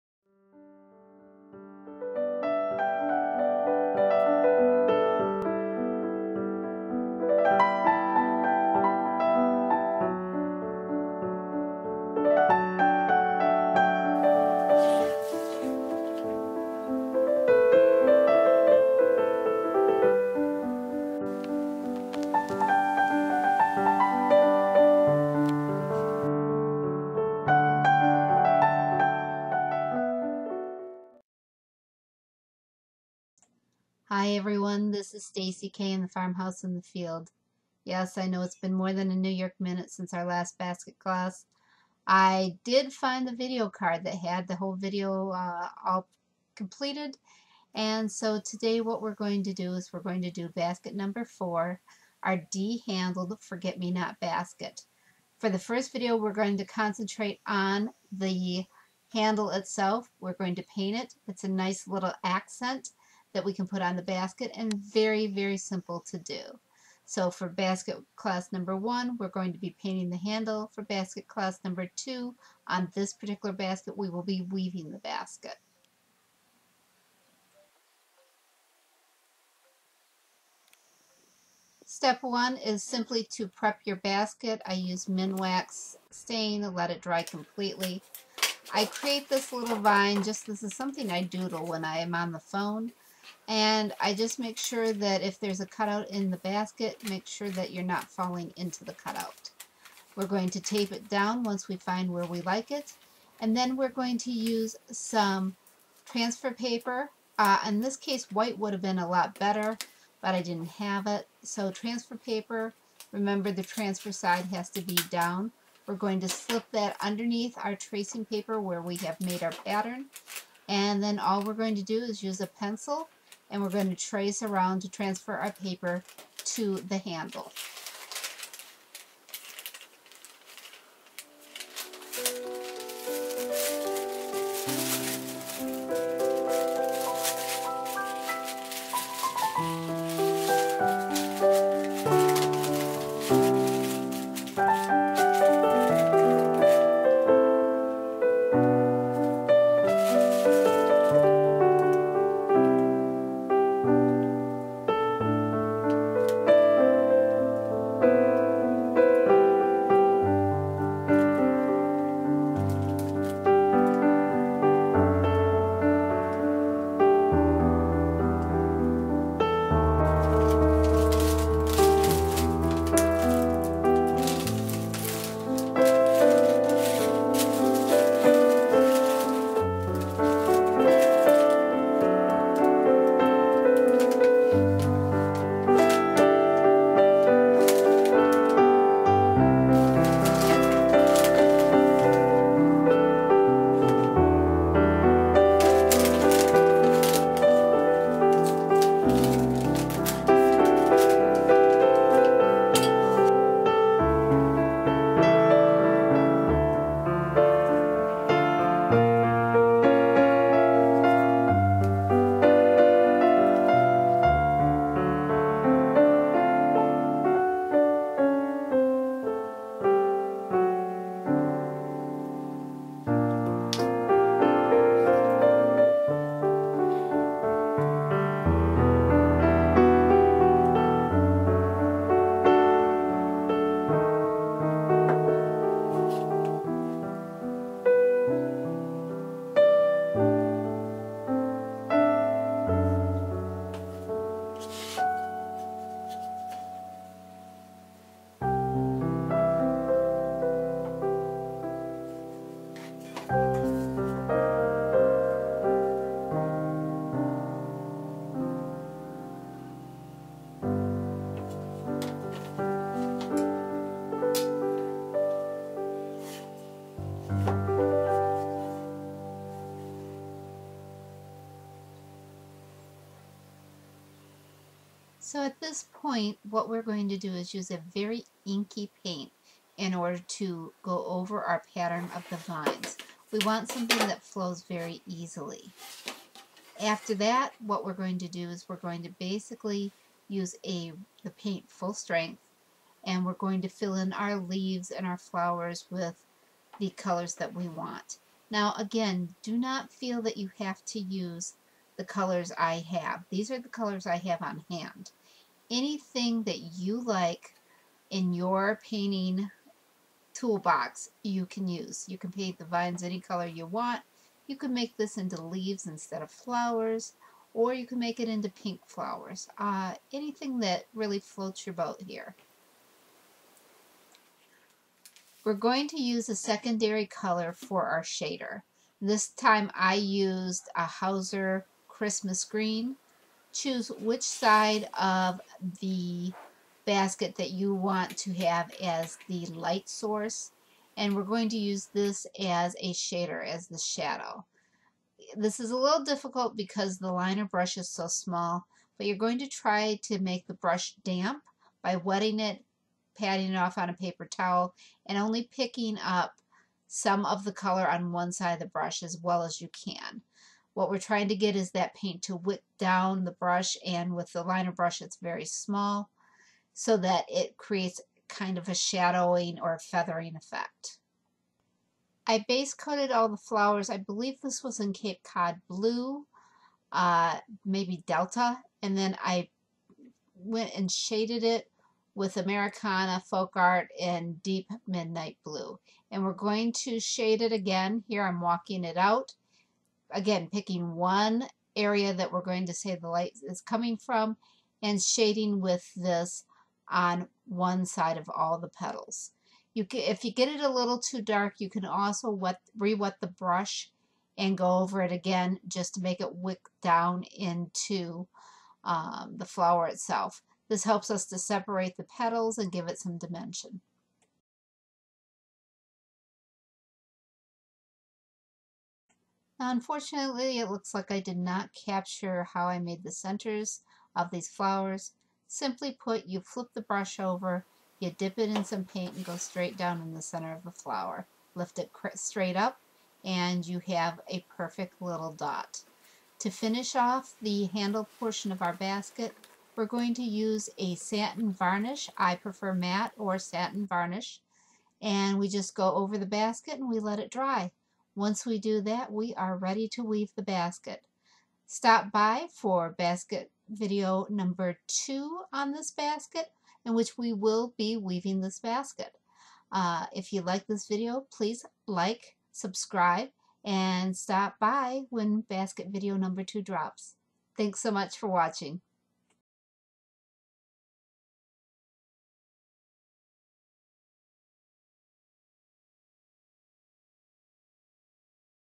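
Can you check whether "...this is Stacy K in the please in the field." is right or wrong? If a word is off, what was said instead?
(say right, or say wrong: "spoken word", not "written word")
wrong: "farmhouse", not "please".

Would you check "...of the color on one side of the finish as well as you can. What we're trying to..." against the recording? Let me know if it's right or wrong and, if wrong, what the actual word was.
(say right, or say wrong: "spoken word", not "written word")
wrong: "brush", not "finish".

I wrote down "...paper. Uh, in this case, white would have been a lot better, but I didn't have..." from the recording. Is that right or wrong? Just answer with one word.
right.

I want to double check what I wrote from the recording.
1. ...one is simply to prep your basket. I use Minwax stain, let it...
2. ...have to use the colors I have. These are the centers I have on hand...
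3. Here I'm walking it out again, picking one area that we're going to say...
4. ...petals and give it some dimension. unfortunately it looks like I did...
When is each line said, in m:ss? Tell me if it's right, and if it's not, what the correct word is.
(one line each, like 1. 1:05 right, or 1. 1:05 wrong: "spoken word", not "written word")
1. 1:22 right
2. 5:00 wrong: "colors", not "centers"
3. 6:28 right
4. 6:52 right.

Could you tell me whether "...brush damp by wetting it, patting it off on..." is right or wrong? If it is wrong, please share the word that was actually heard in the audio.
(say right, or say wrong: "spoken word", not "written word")
right.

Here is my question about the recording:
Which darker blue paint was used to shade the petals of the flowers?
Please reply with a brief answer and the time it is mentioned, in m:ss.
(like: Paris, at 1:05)
Deep Midnight Blue, at 6:24.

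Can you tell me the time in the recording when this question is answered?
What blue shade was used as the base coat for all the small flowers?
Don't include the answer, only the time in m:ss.
6:14.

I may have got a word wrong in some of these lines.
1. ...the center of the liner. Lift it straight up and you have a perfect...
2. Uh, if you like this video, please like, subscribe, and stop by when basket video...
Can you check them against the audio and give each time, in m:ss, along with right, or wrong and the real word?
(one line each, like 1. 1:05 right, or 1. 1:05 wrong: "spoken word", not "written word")
1. 7:10 wrong: "flower", not "liner"
2. 7:39 right.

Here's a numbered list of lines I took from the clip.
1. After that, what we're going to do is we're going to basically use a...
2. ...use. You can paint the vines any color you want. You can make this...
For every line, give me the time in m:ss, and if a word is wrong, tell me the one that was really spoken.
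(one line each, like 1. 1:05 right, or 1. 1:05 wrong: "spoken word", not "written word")
1. 4:46 right
2. 5:11 right.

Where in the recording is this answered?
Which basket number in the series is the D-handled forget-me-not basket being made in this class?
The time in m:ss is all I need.
0:50.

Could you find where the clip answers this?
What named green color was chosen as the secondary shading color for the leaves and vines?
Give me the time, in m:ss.
5:30.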